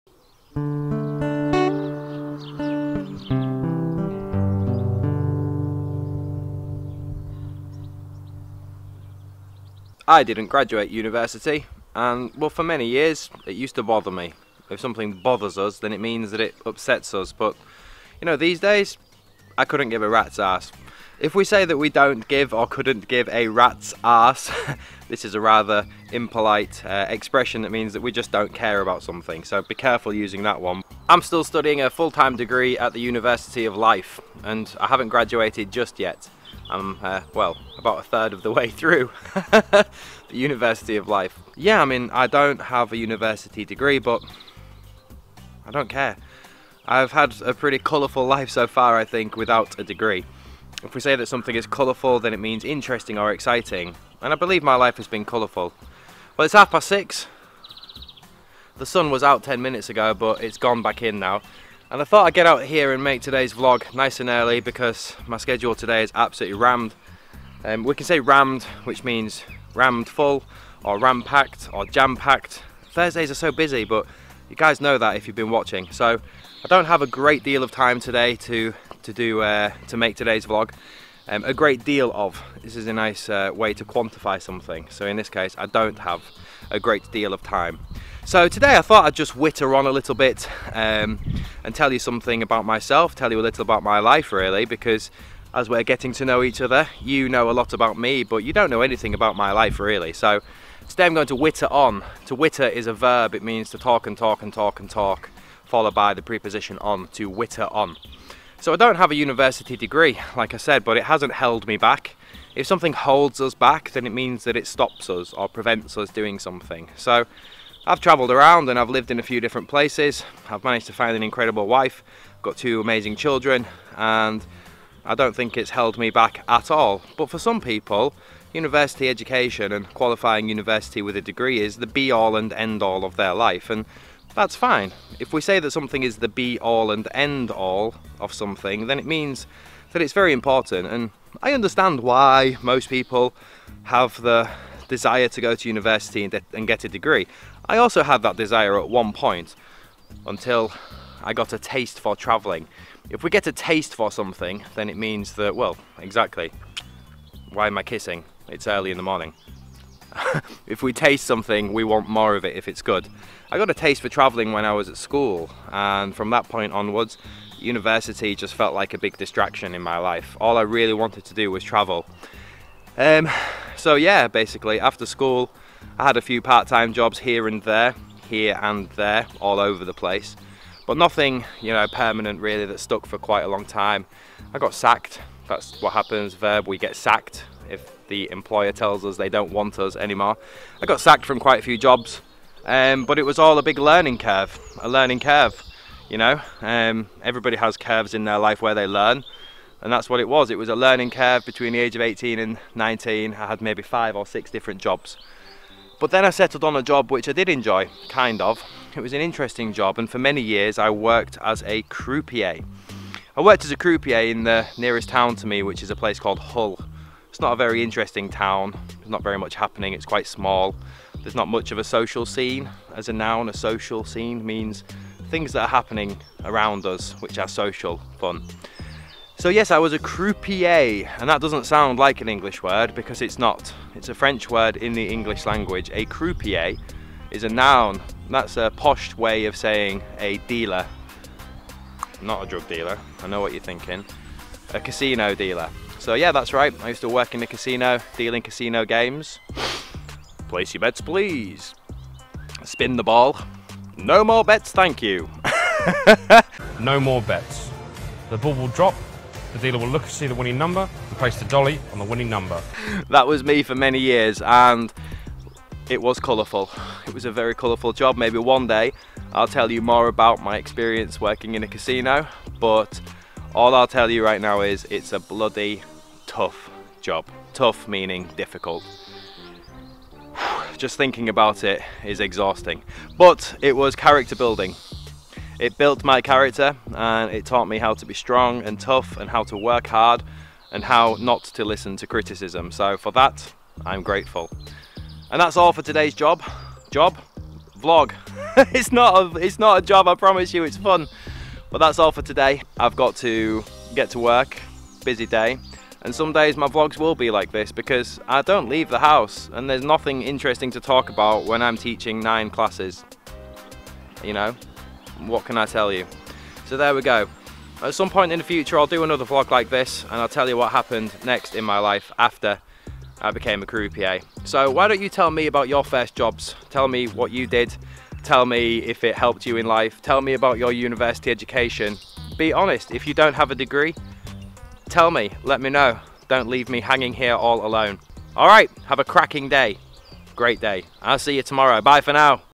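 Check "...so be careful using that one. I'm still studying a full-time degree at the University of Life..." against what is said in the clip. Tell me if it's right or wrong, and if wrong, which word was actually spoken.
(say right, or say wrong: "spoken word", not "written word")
right.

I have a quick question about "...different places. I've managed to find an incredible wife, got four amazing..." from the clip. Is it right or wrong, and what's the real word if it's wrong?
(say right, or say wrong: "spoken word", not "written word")
wrong: "two", not "four".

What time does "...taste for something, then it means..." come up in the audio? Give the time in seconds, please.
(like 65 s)
153 s.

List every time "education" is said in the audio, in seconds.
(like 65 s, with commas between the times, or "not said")
129 s, 331 s.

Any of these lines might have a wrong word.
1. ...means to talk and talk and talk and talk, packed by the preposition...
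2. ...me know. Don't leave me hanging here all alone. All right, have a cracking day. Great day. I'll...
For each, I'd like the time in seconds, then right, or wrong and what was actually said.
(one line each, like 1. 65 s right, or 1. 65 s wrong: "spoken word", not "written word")
1. 103 s wrong: "followed", not "packed"
2. 335 s right.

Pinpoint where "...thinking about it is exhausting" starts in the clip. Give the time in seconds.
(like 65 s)
280 s.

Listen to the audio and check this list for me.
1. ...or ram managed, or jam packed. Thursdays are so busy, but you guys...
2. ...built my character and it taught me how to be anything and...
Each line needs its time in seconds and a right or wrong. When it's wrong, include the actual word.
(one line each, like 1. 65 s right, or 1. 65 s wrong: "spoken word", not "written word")
1. 70 s wrong: "packed", not "managed"
2. 285 s wrong: "strong", not "anything".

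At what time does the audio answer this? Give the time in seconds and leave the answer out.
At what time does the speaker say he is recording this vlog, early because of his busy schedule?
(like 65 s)
56 s.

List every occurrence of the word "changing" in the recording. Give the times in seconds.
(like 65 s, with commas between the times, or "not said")
not said.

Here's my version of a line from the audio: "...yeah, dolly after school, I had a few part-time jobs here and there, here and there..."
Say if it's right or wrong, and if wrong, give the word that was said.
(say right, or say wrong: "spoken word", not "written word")
wrong: "basically", not "dolly".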